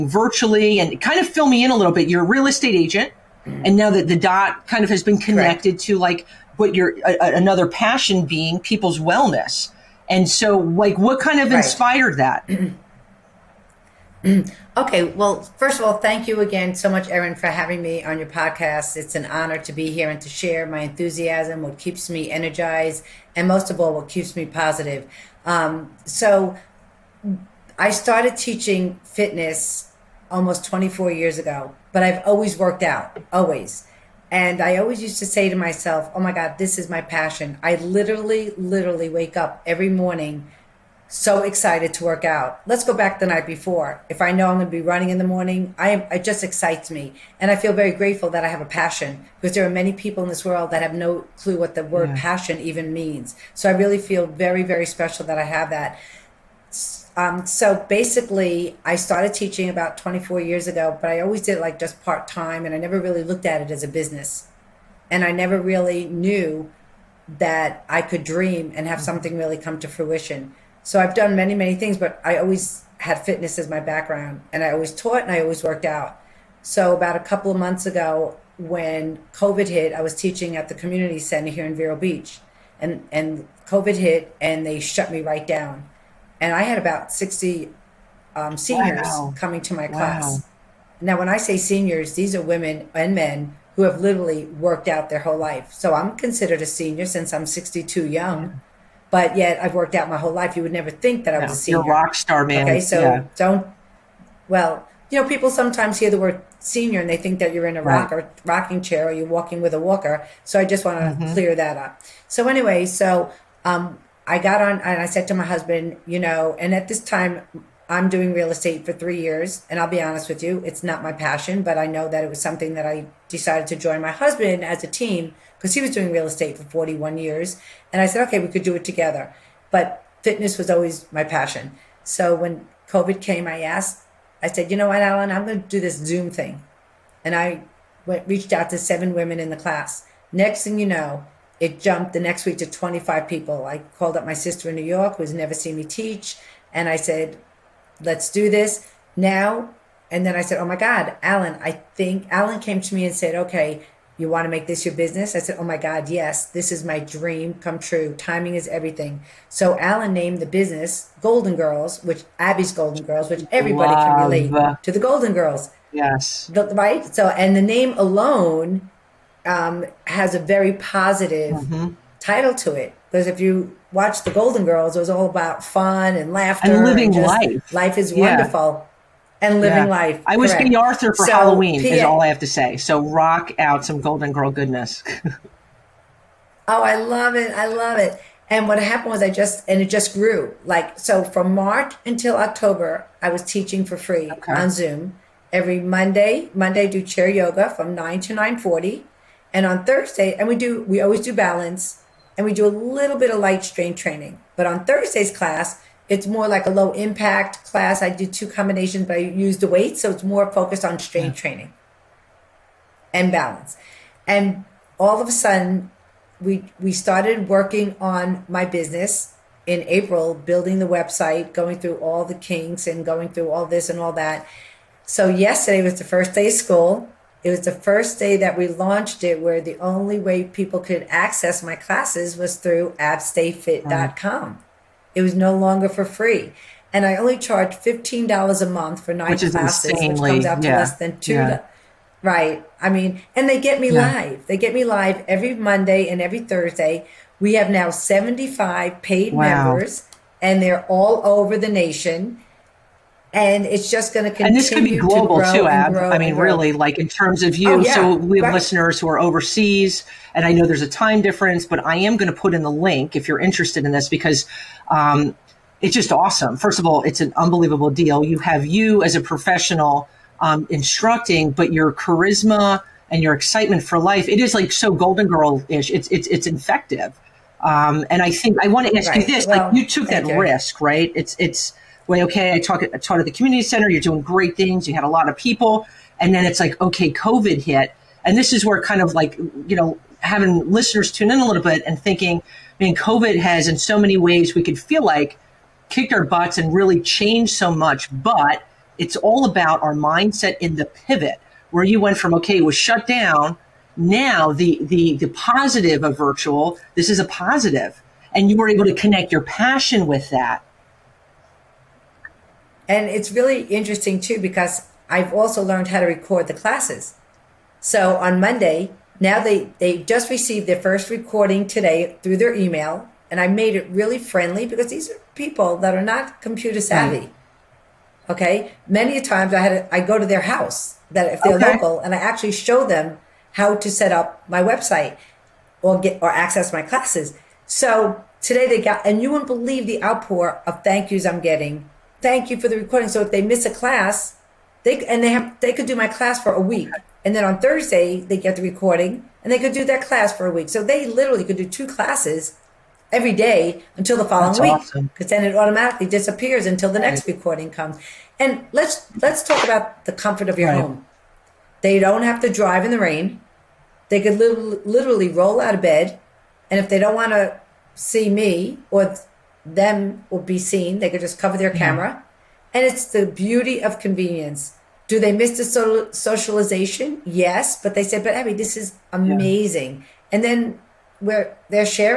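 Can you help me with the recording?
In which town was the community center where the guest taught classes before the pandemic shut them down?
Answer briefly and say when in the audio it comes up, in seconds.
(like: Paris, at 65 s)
Vero Beach, at 81 s.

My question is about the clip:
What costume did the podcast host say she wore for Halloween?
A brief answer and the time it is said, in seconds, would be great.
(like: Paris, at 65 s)
King Arthur, at 180 s.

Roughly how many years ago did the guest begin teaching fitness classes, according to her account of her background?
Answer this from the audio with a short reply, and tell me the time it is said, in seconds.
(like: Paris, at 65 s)
24, at 30 s.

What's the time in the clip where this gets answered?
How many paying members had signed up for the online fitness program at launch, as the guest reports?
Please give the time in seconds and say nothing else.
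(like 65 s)
247 s.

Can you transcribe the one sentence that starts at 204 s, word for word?
But on Thursday's class, it's more like a low impact class.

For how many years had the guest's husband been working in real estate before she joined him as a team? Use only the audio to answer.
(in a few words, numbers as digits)
41.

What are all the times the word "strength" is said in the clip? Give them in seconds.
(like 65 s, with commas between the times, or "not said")
203 s, 210 s.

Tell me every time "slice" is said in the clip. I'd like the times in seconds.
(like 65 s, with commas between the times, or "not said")
not said.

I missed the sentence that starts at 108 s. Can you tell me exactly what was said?
rock or rocking chair or you're walking with a walker.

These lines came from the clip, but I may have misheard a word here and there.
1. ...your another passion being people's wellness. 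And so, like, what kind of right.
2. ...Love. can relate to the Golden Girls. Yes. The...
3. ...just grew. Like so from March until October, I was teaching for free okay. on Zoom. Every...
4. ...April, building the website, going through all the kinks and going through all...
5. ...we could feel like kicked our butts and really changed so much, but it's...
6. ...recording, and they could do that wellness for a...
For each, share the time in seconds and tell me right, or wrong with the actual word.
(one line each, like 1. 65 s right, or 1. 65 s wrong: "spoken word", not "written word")
1. 6 s right
2. 163 s right
3. 189 s right
4. 219 s right
5. 294 s right
6. 348 s wrong: "class", not "wellness".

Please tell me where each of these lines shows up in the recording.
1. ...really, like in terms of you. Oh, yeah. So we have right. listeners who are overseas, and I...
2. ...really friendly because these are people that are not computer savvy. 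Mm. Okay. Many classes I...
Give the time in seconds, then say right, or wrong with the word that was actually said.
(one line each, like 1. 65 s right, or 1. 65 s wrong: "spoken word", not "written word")
1. 256 s right
2. 323 s wrong: "times", not "classes".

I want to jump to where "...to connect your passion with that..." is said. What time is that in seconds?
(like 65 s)
308 s.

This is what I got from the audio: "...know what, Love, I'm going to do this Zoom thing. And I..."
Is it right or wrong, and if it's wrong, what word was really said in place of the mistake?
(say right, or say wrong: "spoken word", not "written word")
wrong: "Alan", not "Love".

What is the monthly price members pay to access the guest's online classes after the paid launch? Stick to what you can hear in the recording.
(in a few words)
$15.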